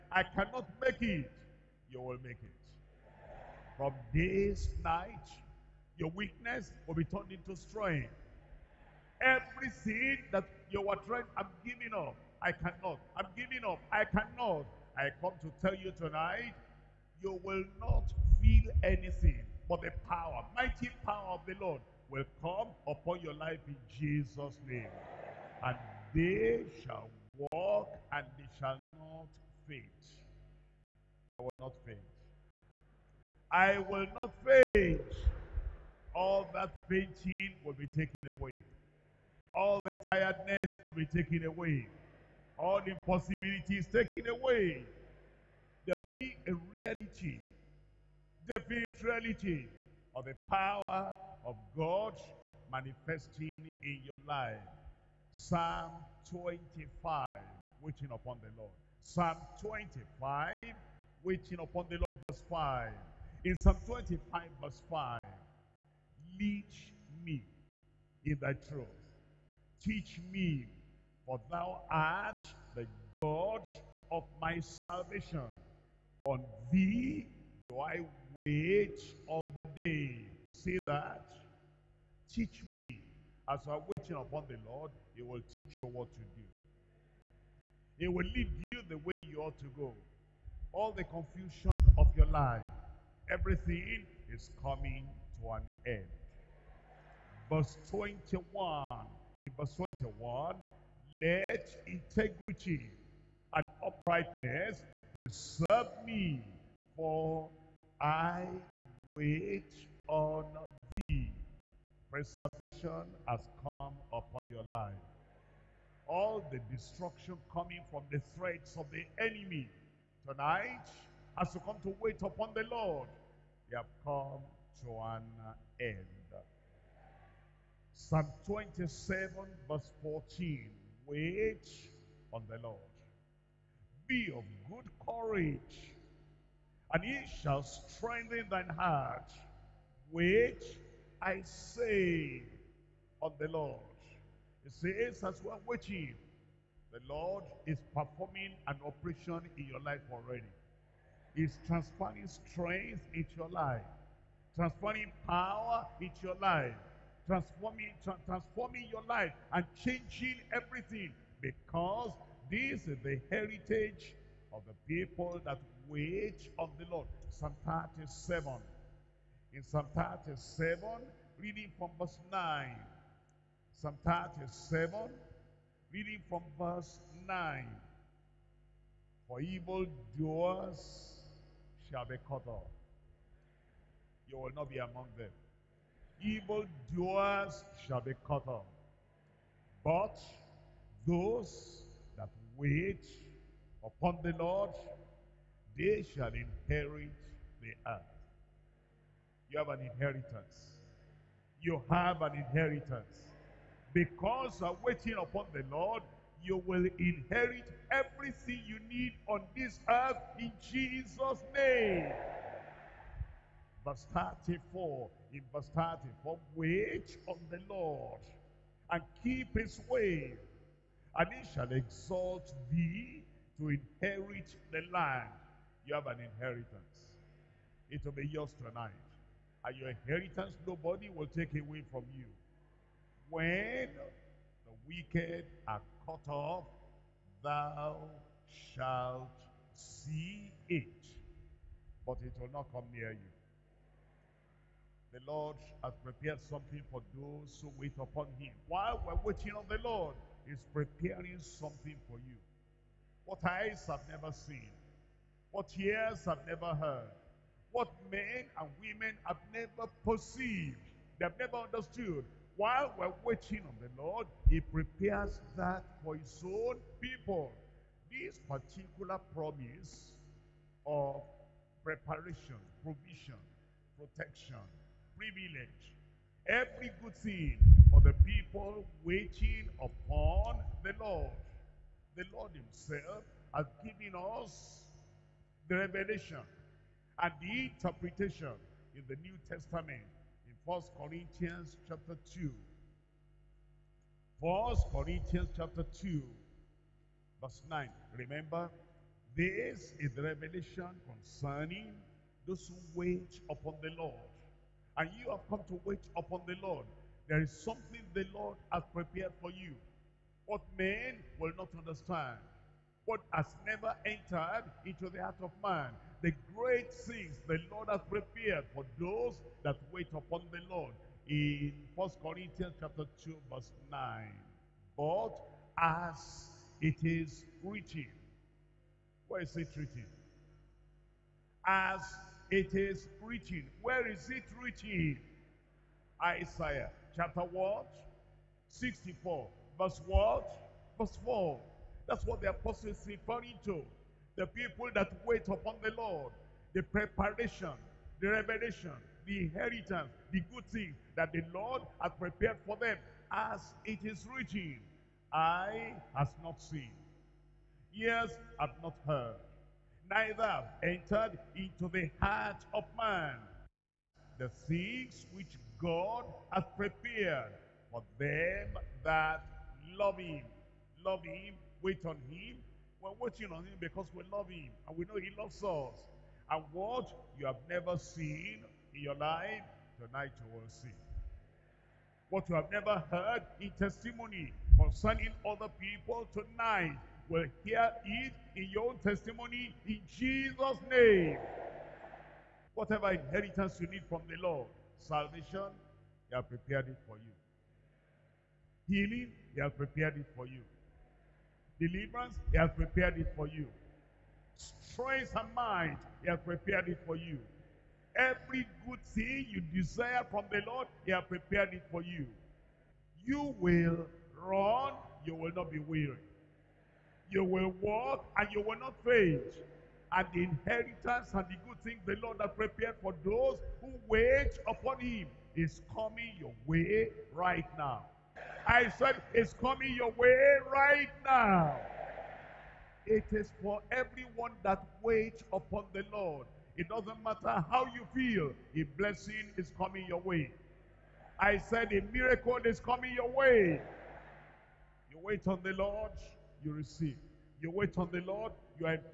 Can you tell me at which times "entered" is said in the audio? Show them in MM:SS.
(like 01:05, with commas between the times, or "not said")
05:14, 06:00.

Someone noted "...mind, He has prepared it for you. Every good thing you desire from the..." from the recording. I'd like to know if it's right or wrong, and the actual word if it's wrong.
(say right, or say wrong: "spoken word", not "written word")
right.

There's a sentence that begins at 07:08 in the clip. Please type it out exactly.
I said it's coming your way right now.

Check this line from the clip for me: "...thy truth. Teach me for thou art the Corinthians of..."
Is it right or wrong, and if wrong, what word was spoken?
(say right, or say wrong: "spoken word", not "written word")
wrong: "God", not "Corinthians".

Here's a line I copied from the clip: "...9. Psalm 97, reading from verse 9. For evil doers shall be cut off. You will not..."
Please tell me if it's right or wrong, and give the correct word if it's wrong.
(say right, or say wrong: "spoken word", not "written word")
wrong: "37", not "97".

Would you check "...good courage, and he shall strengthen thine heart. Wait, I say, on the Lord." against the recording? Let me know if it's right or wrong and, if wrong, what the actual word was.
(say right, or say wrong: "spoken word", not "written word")
right.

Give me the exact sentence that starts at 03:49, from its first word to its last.
And your inheritance nobody will take away from you.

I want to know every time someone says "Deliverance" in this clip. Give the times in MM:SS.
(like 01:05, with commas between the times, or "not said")
06:41.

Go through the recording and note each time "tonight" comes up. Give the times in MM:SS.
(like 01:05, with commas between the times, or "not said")
00:15, 02:00, 03:48, 06:19, 06:26.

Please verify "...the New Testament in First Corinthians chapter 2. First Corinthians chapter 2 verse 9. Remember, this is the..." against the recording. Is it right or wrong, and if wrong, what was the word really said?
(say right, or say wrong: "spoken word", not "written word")
right.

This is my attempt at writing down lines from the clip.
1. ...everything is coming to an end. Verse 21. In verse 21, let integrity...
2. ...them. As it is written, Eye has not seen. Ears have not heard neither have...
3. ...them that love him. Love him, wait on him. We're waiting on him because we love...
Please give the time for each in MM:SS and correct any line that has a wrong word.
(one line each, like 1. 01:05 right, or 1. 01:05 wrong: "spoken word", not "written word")
1. 01:33 right
2. 05:52 right
3. 06:08 right.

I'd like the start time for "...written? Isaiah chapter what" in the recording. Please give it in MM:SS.
05:34.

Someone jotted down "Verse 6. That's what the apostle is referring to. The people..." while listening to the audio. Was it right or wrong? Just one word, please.
wrong.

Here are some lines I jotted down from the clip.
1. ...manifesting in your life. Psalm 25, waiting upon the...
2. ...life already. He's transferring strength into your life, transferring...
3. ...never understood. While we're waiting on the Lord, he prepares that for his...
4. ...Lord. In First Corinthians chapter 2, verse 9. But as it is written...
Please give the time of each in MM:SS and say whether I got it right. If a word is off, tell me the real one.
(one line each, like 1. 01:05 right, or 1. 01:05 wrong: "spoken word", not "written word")
1. 00:52 right
2. 02:29 right
3. 04:21 right
4. 05:20 right.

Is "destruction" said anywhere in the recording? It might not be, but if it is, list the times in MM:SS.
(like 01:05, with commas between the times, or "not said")
01:56.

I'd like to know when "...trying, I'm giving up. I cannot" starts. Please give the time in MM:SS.
00:11.